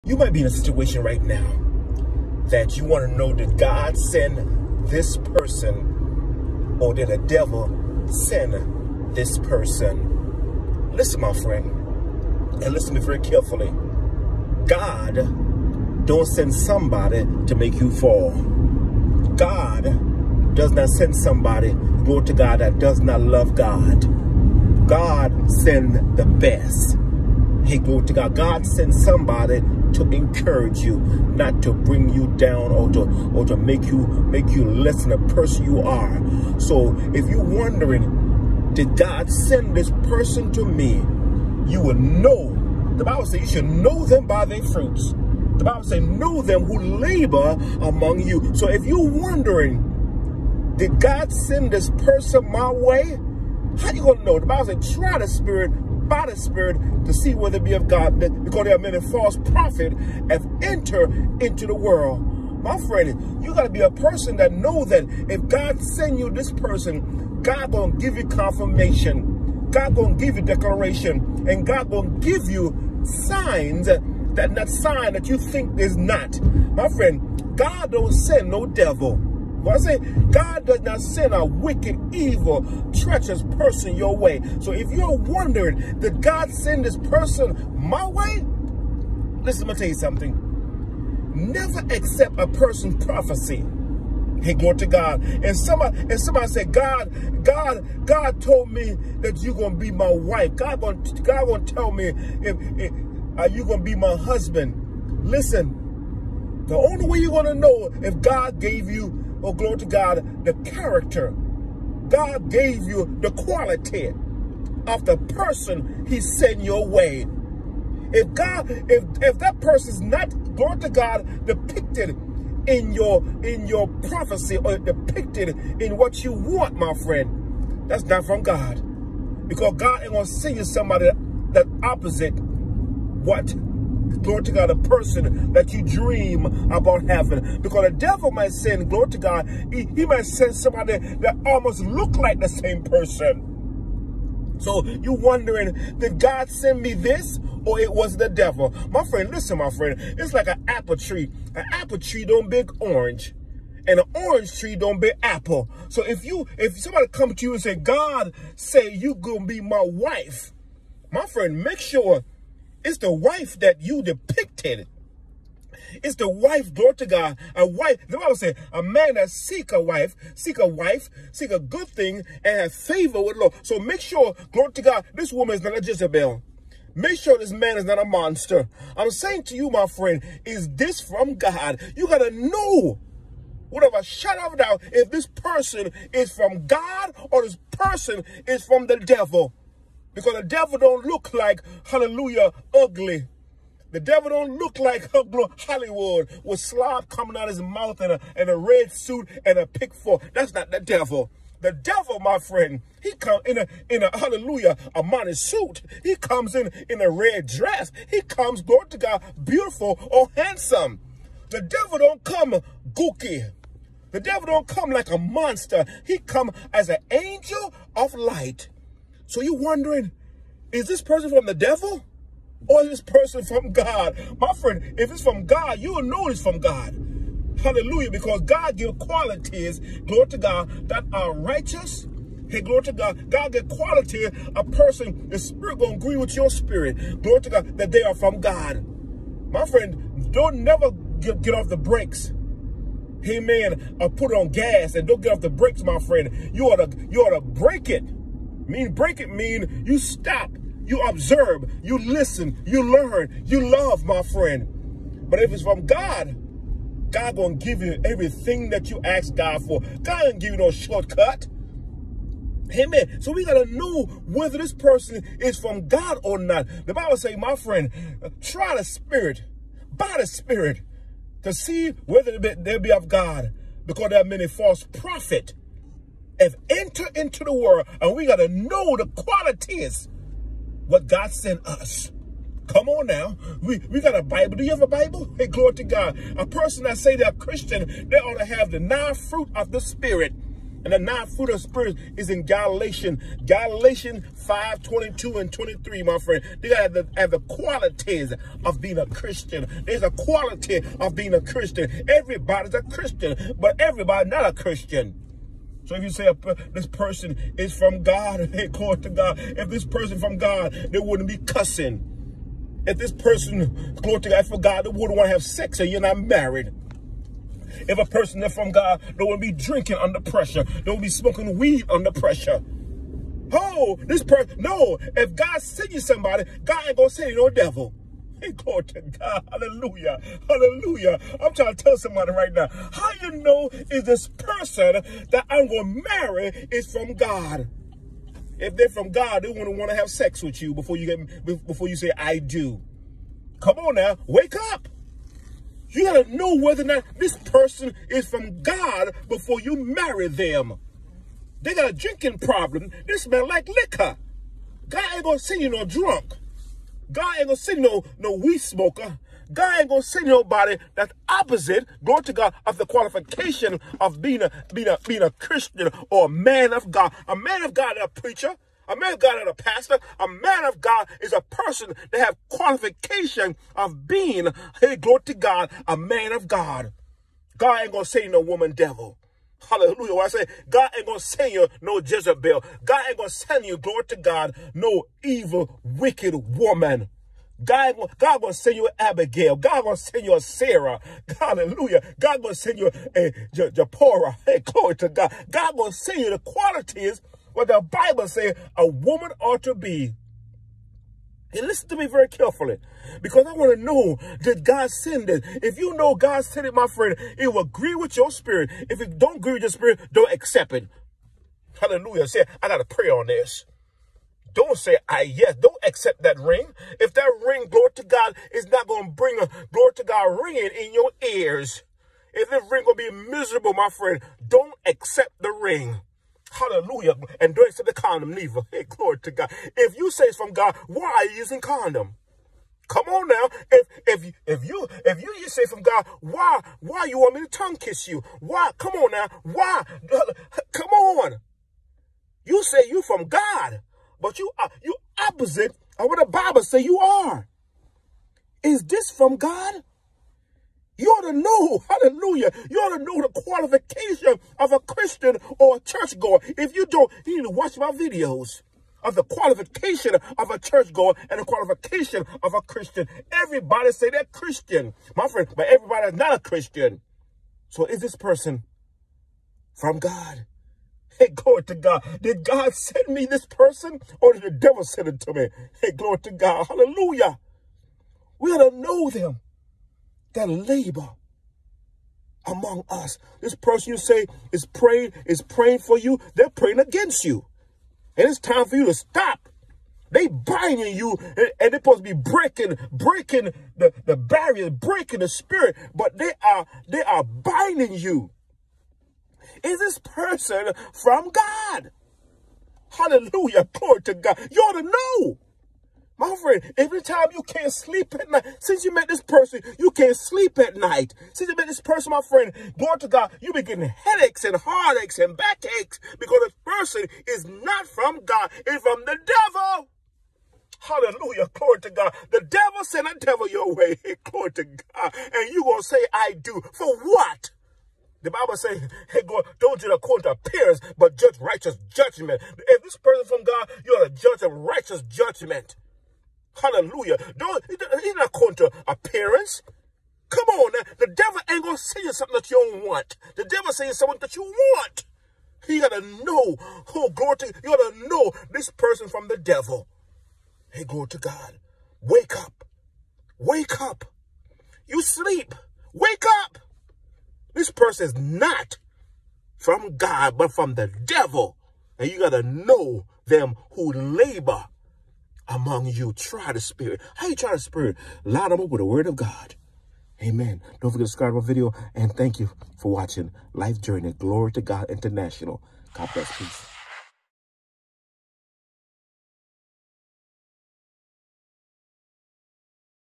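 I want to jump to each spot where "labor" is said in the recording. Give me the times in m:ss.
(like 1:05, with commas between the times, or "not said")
0:46, 8:00, 9:23.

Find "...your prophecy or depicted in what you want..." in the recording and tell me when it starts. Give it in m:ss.
2:03.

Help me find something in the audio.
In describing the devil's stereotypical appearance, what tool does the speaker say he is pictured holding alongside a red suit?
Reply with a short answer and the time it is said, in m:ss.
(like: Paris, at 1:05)
Pick fork, at 3:19.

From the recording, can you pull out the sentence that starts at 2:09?
Because God ain't gonna send you somebody that opposite what glory to God, a person that you dream about having.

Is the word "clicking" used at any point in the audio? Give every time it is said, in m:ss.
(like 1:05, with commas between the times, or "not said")
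not said.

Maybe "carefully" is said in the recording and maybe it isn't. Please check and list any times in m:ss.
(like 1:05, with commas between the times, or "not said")
0:13, 6:42.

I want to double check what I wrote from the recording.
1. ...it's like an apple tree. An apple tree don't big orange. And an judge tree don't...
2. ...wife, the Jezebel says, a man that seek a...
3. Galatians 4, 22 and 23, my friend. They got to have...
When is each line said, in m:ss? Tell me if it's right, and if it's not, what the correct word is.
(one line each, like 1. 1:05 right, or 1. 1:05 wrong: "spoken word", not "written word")
1. 2:29 wrong: "orange", not "judge"
2. 2:47 wrong: "Bible", not "Jezebel"
3. 4:53 wrong: "5", not "4".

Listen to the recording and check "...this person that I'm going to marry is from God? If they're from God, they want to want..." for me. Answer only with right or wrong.
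right.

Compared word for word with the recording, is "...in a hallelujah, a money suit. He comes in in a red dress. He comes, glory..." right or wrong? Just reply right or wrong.
right.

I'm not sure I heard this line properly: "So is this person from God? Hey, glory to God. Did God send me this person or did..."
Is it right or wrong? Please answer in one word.
right.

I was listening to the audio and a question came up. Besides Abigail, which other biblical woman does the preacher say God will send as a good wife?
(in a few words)
Sarah.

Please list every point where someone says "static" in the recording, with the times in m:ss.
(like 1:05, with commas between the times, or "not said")
not said.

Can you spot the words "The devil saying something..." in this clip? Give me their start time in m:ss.
9:03.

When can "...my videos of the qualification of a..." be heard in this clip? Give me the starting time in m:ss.
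7:37.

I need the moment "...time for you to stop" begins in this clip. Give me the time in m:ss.
8:08.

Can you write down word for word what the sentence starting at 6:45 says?
If you know God sent it, my friend, it will agree with your spirit.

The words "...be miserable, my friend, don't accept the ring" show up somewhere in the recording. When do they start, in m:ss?
7:03.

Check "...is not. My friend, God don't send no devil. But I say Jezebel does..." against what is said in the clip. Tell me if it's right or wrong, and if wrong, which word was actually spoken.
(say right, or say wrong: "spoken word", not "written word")
wrong: "God", not "Jezebel".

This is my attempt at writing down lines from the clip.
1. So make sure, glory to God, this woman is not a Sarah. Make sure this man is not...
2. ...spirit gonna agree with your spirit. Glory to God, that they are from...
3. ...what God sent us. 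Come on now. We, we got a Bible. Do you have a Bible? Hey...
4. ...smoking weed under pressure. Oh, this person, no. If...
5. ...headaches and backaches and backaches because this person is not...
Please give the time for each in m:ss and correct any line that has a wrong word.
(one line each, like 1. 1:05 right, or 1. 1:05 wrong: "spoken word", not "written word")
1. 2:53 wrong: "Jezebel", not "Sarah"
2. 3:55 right
3. 4:40 right
4. 5:21 right
5. 8:33 wrong: "heartaches", not "backaches".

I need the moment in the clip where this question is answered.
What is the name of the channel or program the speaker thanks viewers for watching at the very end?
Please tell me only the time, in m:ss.
9:33.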